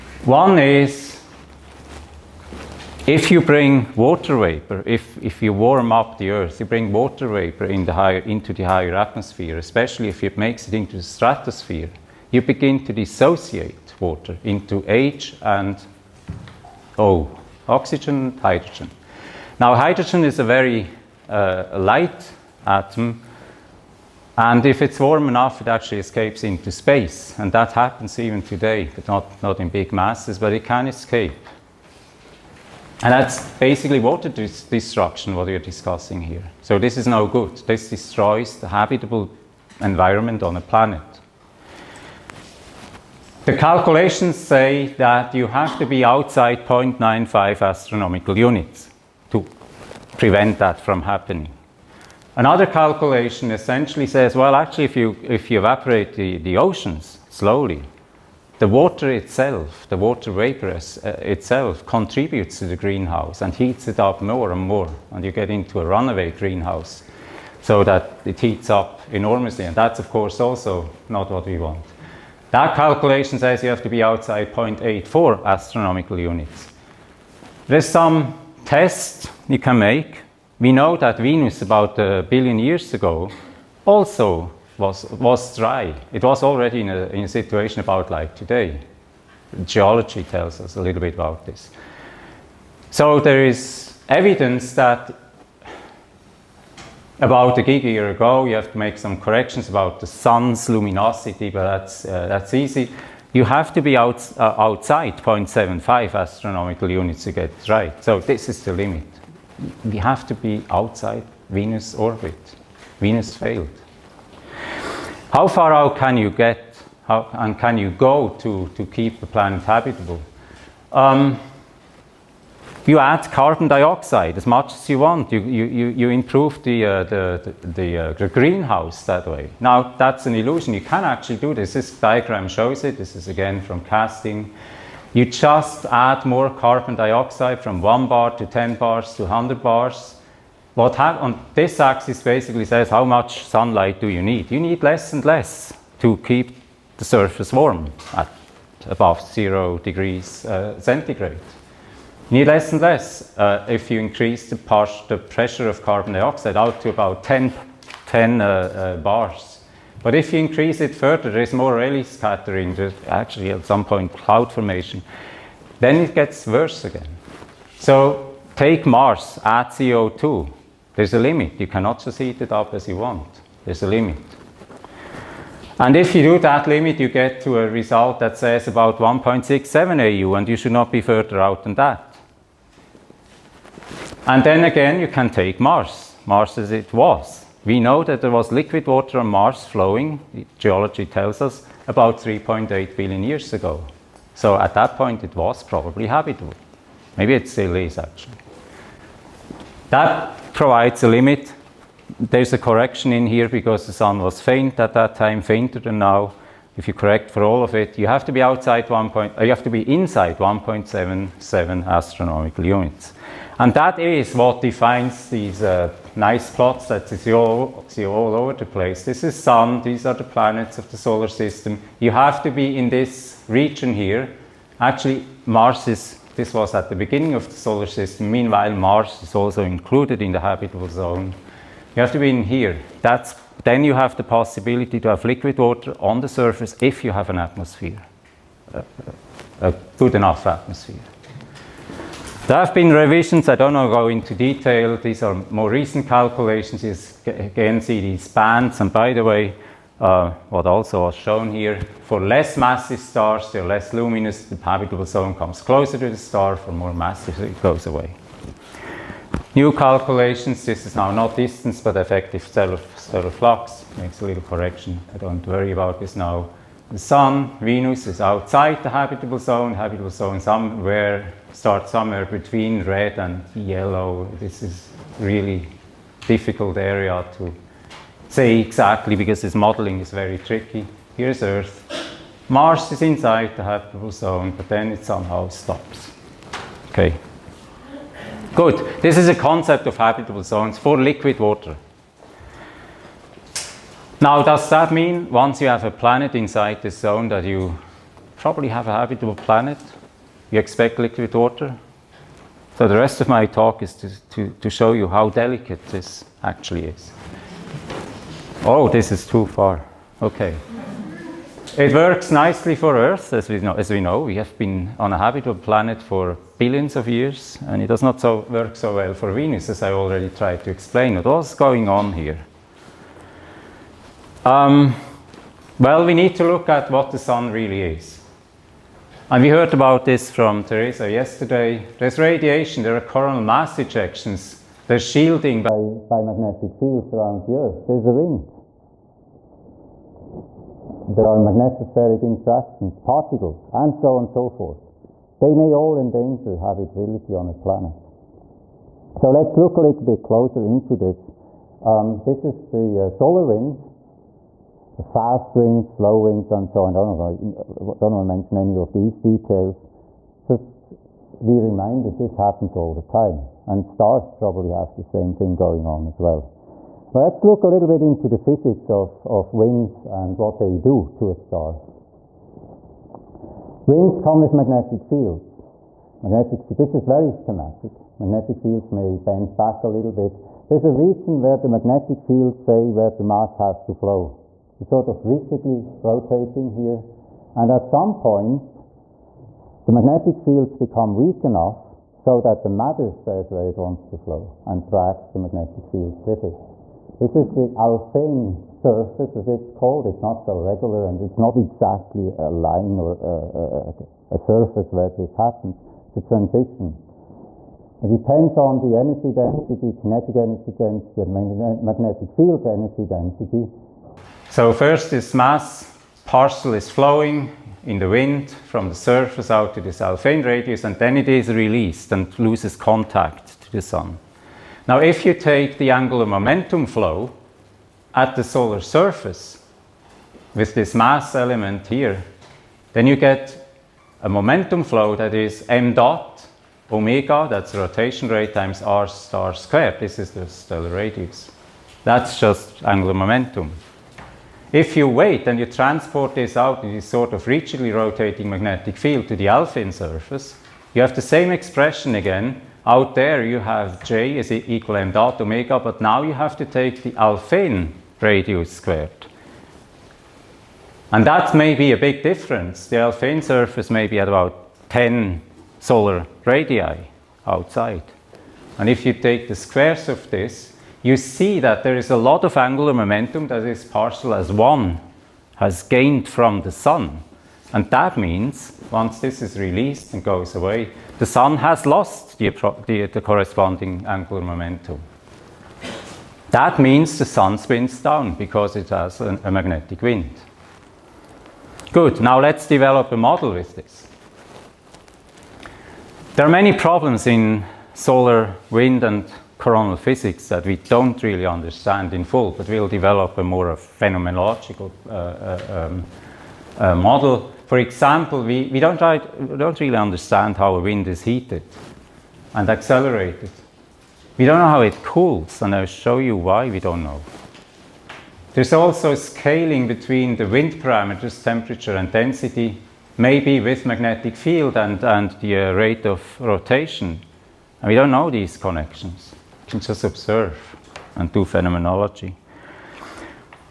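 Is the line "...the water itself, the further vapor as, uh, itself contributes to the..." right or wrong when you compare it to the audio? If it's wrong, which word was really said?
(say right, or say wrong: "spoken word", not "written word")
wrong: "water", not "further".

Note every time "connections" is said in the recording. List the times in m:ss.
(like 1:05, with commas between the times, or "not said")
8:48.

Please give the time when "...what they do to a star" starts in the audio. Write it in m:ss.
6:10.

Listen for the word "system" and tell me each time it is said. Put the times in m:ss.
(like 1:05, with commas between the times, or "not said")
3:41, 3:47.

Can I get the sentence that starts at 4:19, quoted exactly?
New calculations, this is now not distance but effective stellar, stellar flux, makes a little correction, I don't worry about this now.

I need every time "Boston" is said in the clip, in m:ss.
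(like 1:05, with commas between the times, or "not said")
not said.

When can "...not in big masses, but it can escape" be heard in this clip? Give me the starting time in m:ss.
0:29.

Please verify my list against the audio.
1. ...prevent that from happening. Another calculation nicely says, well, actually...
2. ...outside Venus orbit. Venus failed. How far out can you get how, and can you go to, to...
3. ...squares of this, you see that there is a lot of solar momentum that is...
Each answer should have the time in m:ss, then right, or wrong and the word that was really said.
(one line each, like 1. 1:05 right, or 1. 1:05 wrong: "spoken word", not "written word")
1. 0:50 wrong: "essentially", not "nicely"
2. 1:50 right
3. 7:49 wrong: "angular", not "solar".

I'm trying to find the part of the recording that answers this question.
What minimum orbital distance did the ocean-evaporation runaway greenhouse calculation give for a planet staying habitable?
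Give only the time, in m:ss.
1:14.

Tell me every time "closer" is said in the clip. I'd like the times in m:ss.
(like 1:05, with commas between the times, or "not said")
4:15, 5:50.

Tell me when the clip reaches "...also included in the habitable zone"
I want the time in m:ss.
3:49.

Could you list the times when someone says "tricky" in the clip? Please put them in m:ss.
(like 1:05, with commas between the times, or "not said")
4:40.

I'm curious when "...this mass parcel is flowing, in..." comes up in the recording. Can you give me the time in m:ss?
6:55.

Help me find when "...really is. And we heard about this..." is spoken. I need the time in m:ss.
5:27.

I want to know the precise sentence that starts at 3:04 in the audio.
And then again, you can take Mars, Mars as it was.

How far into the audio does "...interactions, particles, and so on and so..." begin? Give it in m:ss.
5:42.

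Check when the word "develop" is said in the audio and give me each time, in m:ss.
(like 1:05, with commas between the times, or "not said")
8:12, 8:22.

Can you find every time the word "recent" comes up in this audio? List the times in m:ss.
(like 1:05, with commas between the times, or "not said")
4:05.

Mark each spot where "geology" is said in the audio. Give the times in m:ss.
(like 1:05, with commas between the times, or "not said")
1:29, 3:10.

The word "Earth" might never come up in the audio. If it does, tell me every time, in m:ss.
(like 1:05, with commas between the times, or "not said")
0:06, 4:41, 5:12, 5:37.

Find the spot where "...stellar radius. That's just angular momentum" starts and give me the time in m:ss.
7:20.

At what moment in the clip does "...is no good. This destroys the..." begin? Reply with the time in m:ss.
0:36.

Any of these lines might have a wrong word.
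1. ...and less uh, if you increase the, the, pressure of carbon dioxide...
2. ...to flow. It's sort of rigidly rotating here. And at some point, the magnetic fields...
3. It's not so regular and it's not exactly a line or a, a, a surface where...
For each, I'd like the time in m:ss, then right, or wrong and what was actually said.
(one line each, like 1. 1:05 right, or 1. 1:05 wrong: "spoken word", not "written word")
1. 2:32 right
2. 6:23 right
3. 6:40 right.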